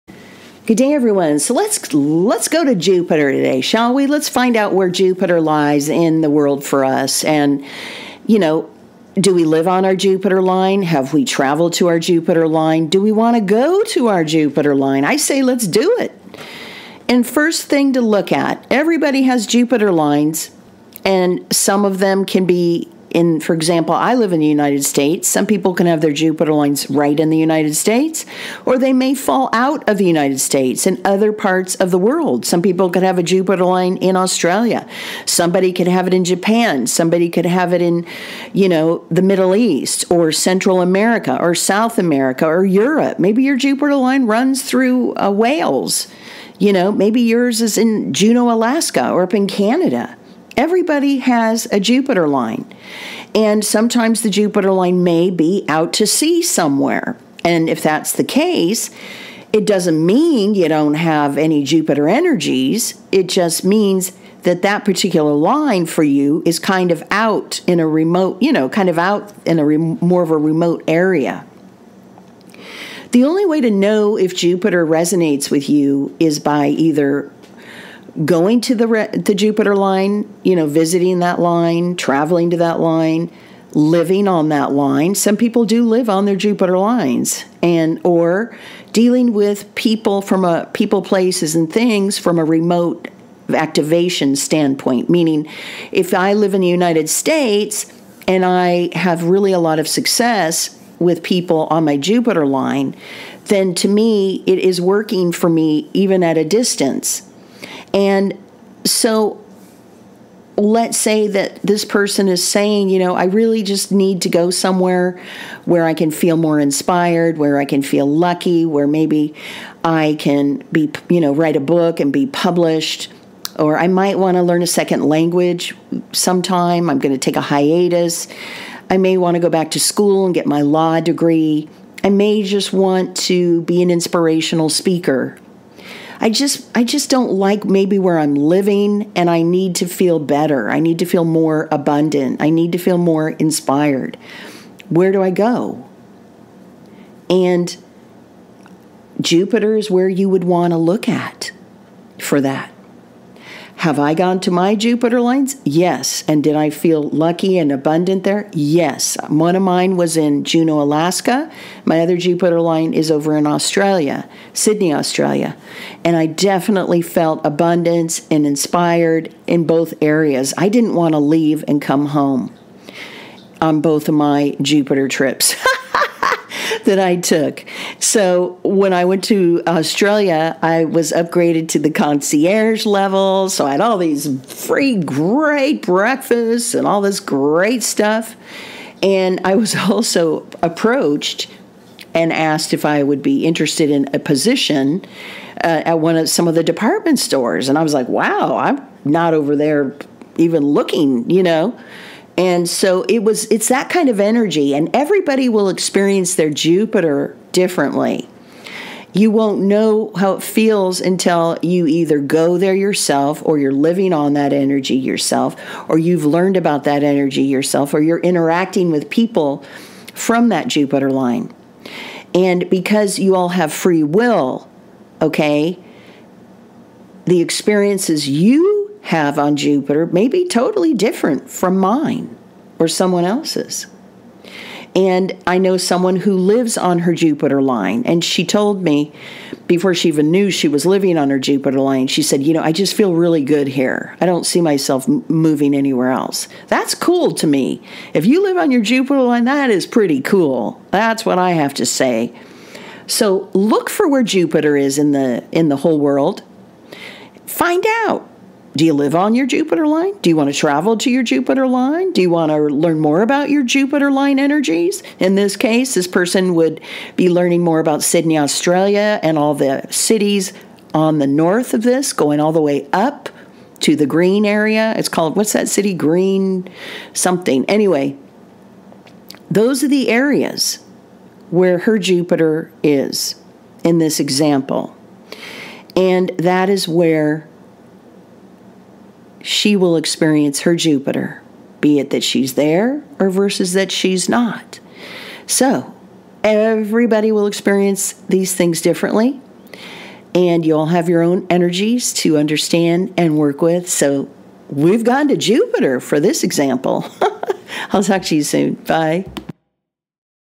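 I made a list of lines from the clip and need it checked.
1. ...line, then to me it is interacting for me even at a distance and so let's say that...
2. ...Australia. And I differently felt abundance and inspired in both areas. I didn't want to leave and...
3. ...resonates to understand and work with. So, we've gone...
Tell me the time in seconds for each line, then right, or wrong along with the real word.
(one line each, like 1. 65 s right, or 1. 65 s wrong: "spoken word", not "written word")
1. 102 s wrong: "working", not "interacting"
2. 164 s wrong: "definitely", not "differently"
3. 301 s wrong: "energies", not "resonates".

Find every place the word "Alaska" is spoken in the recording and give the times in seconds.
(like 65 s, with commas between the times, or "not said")
48 s, 160 s.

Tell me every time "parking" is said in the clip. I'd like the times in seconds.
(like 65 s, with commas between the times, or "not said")
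not said.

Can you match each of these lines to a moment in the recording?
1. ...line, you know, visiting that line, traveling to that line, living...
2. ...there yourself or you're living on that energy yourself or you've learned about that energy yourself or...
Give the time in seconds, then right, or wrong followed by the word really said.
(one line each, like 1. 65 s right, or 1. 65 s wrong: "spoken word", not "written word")
1. 79 s right
2. 212 s right.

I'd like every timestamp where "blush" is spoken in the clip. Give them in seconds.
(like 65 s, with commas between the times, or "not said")
not said.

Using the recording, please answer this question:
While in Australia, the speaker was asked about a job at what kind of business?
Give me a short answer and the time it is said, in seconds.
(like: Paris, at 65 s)
department stores, at 196 s.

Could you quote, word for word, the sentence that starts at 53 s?
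And sometimes the Jupiter line may be out to sea somewhere.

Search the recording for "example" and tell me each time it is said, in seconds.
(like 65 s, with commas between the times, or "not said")
23 s, 284 s, 306 s.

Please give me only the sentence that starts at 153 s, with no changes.
Have I gone to my Jupiter lines?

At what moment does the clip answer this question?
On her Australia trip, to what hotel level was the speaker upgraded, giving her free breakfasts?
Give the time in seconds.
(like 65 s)
181 s.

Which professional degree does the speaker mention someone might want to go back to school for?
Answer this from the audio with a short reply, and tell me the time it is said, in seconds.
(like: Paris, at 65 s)
law degree, at 130 s.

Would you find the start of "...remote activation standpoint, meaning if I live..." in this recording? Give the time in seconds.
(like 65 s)
92 s.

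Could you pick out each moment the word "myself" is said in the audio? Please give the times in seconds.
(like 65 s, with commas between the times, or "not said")
244 s.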